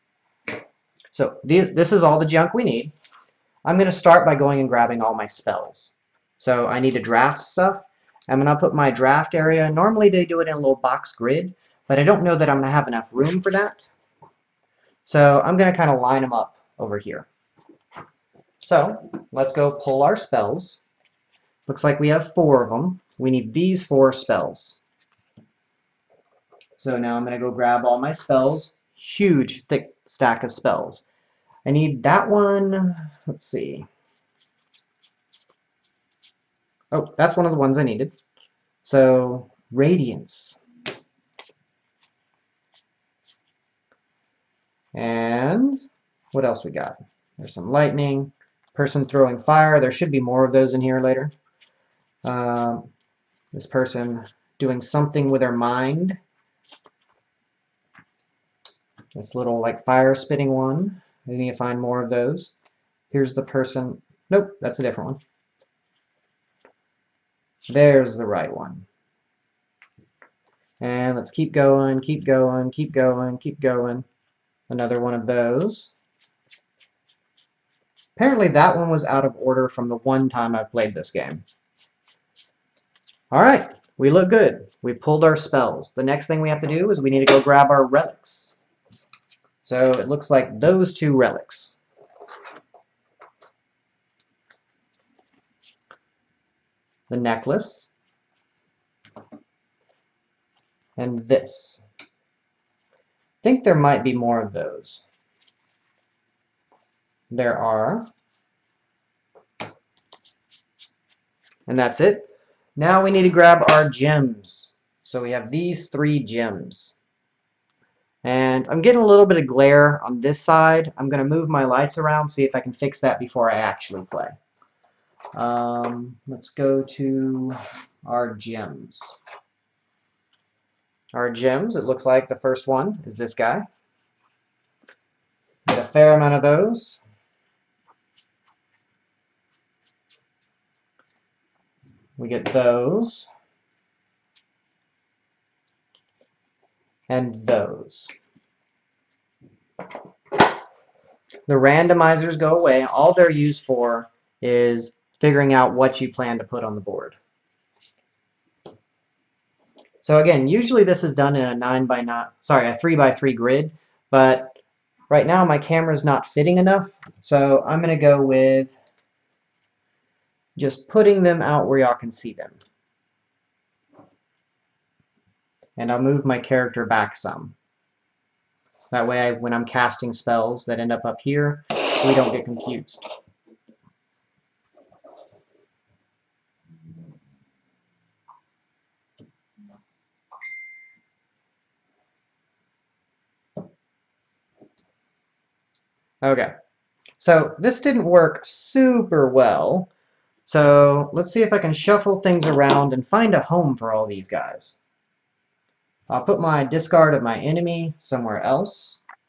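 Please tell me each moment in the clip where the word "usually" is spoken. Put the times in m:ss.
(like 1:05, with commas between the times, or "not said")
2:40.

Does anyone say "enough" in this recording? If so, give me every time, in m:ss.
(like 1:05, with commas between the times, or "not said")
0:12, 2:46.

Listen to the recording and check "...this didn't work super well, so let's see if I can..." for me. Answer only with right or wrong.
right.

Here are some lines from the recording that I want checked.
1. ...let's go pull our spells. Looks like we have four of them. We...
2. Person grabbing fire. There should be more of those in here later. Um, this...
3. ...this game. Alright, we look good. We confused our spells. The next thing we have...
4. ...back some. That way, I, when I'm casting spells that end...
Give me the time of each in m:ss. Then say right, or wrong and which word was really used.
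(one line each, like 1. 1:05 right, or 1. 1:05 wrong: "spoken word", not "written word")
1. 0:19 right
2. 0:48 wrong: "throwing", not "grabbing"
3. 1:20 wrong: "pulled", not "confused"
4. 2:56 right.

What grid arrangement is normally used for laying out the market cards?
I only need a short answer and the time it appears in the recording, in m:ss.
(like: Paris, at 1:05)
3 by 3, at 2:42.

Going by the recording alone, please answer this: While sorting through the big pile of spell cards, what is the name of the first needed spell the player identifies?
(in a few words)
Radiance.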